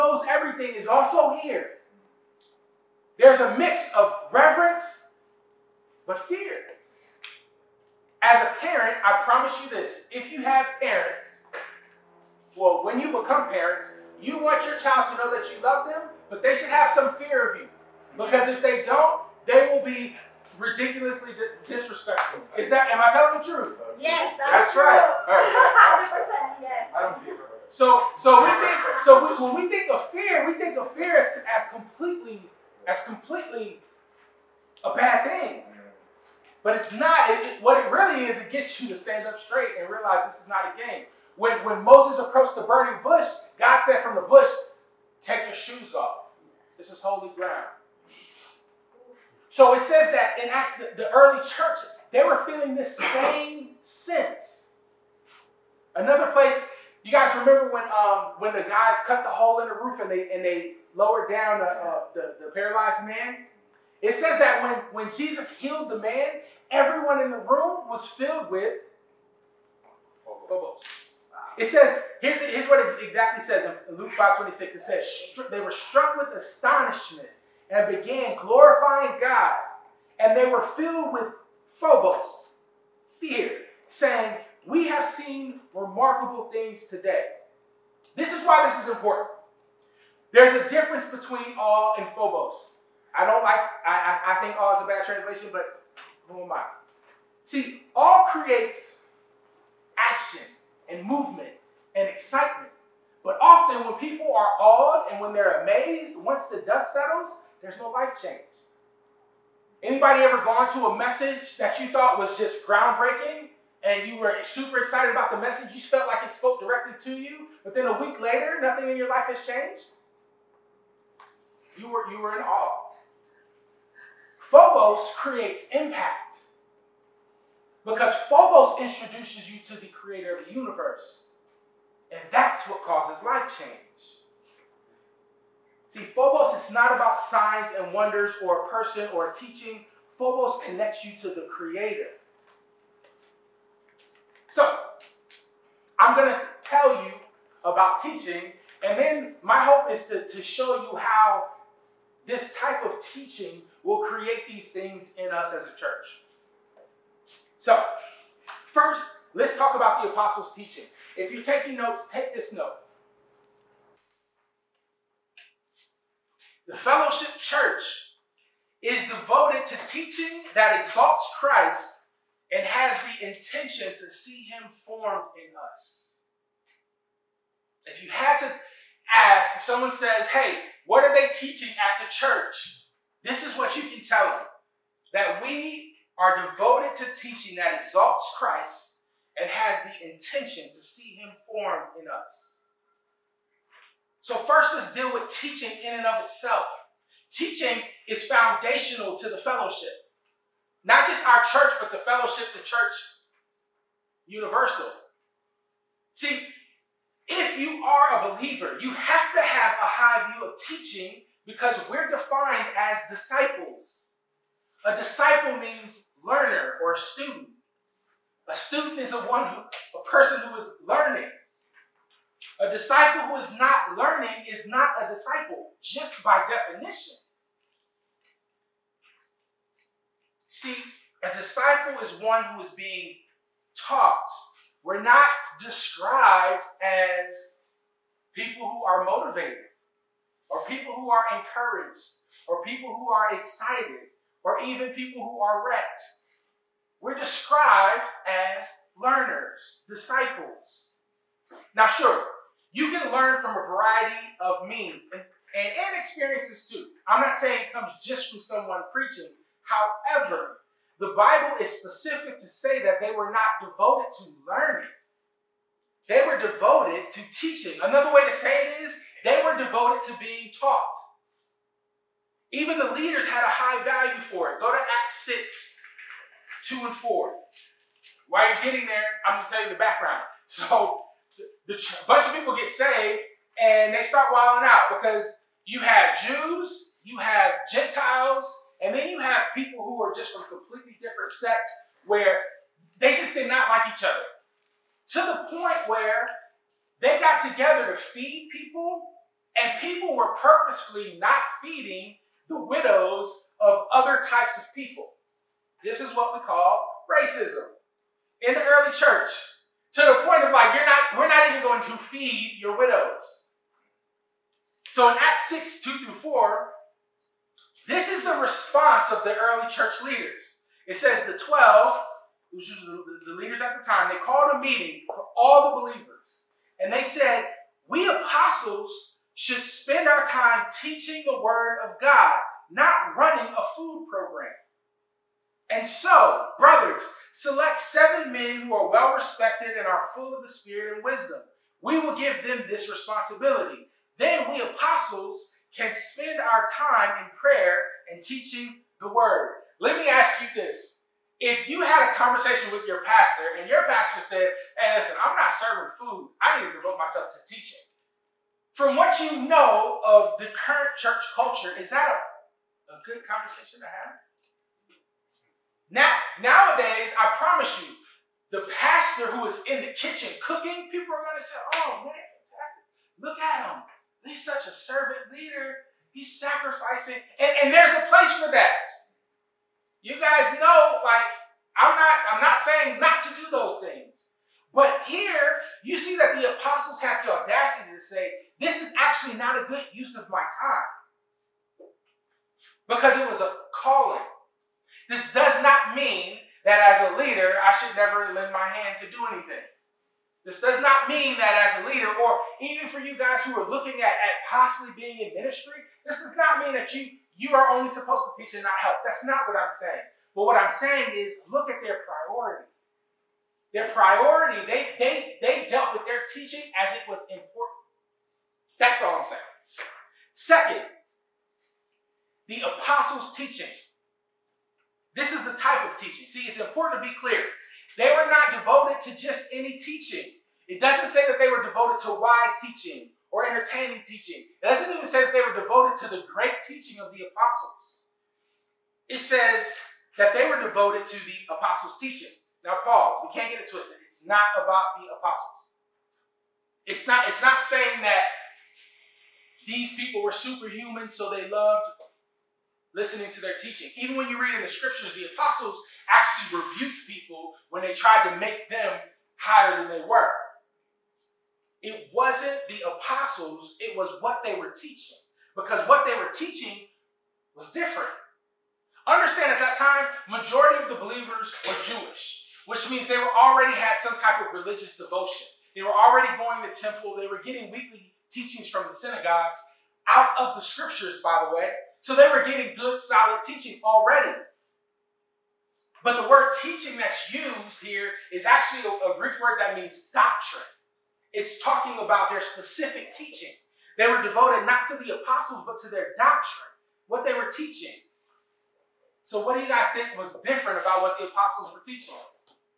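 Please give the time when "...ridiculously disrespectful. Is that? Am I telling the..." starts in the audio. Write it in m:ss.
0:20.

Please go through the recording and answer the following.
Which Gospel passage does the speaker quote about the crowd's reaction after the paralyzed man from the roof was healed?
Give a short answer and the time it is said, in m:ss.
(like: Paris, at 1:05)
Luke 5:26, at 1:13.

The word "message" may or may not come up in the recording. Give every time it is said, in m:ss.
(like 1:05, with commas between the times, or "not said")
1:50, 1:55.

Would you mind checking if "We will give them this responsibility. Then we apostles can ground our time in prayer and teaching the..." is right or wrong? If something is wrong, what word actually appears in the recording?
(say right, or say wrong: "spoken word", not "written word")
wrong: "spend", not "ground".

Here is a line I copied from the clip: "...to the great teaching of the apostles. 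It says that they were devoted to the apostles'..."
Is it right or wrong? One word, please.
right.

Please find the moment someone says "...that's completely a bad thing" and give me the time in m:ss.
0:32.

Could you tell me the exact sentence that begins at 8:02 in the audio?
So they were getting good, solid teaching already.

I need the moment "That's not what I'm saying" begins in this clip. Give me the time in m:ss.
6:49.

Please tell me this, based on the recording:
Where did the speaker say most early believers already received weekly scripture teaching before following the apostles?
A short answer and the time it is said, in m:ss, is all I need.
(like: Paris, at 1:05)
The synagogues, at 7:58.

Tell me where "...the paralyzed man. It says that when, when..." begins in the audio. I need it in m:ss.
1:02.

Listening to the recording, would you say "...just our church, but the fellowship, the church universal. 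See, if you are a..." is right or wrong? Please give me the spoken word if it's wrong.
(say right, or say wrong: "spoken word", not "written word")
right.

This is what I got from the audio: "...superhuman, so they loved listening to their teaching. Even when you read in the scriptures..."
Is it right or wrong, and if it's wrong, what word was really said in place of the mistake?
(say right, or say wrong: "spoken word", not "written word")
right.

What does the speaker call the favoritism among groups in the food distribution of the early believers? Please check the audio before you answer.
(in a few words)
Racism.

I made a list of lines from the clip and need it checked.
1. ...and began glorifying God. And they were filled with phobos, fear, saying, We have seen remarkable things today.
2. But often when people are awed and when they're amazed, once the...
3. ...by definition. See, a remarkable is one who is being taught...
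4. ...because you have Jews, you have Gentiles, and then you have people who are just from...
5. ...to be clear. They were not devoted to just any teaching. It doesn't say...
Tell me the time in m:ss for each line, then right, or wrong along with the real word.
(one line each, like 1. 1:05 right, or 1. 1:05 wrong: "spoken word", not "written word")
1. 1:17 right
2. 1:43 right
3. 3:46 wrong: "disciple", not "remarkable"
4. 4:45 right
5. 7:07 right.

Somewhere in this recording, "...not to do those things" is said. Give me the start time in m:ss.
6:22.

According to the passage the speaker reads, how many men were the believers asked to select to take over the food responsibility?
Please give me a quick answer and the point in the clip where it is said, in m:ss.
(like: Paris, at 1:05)
7, at 5:37.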